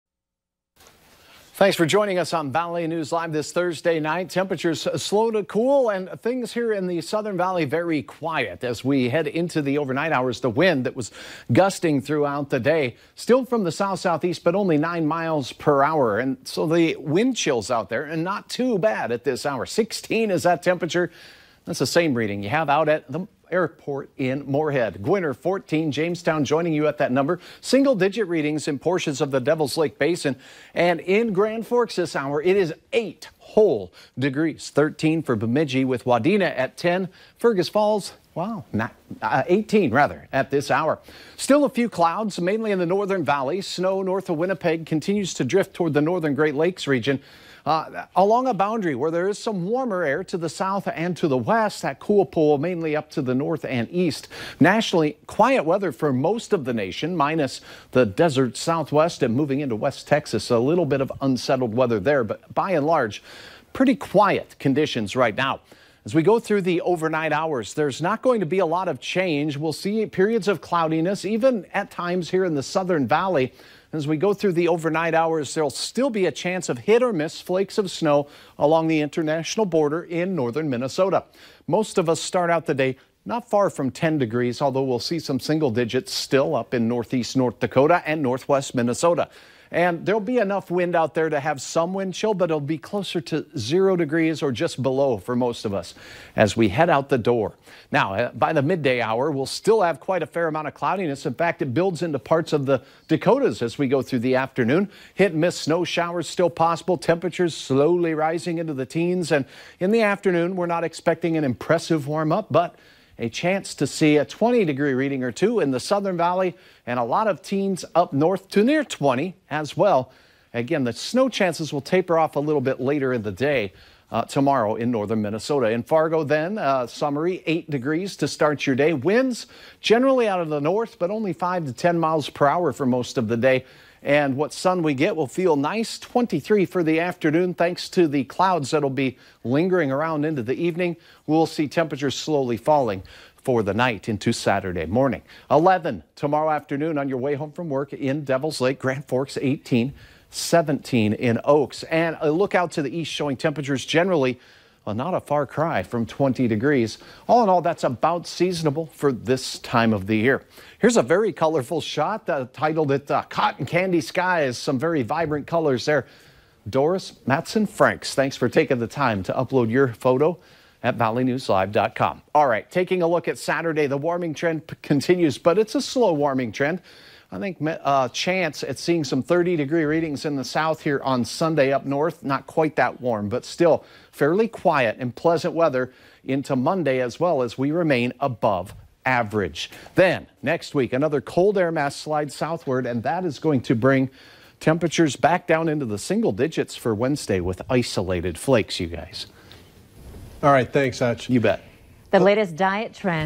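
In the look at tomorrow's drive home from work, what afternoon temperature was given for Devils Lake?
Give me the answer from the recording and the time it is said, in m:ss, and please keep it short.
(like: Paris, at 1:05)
11, at 2:25.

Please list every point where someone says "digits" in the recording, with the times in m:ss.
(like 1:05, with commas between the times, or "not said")
0:27, 1:25, 3:16.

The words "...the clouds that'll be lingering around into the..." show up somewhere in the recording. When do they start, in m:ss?
2:18.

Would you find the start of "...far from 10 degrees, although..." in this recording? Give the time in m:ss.
1:23.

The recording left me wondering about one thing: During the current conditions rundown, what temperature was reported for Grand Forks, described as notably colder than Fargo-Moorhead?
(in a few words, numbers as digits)
8 degrees.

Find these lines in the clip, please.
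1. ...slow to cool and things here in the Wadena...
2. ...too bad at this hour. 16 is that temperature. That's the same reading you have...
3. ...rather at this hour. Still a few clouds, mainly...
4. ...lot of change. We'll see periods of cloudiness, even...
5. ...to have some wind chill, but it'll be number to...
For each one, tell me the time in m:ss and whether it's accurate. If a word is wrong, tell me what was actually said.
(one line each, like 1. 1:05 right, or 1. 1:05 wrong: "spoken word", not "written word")
1. 0:04 wrong: "Southern", not "Wadena"
2. 0:18 right
3. 0:39 right
4. 1:08 right
5. 1:31 wrong: "closer", not "number".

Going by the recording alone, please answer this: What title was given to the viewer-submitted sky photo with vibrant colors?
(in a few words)
Cotton Candy Skies.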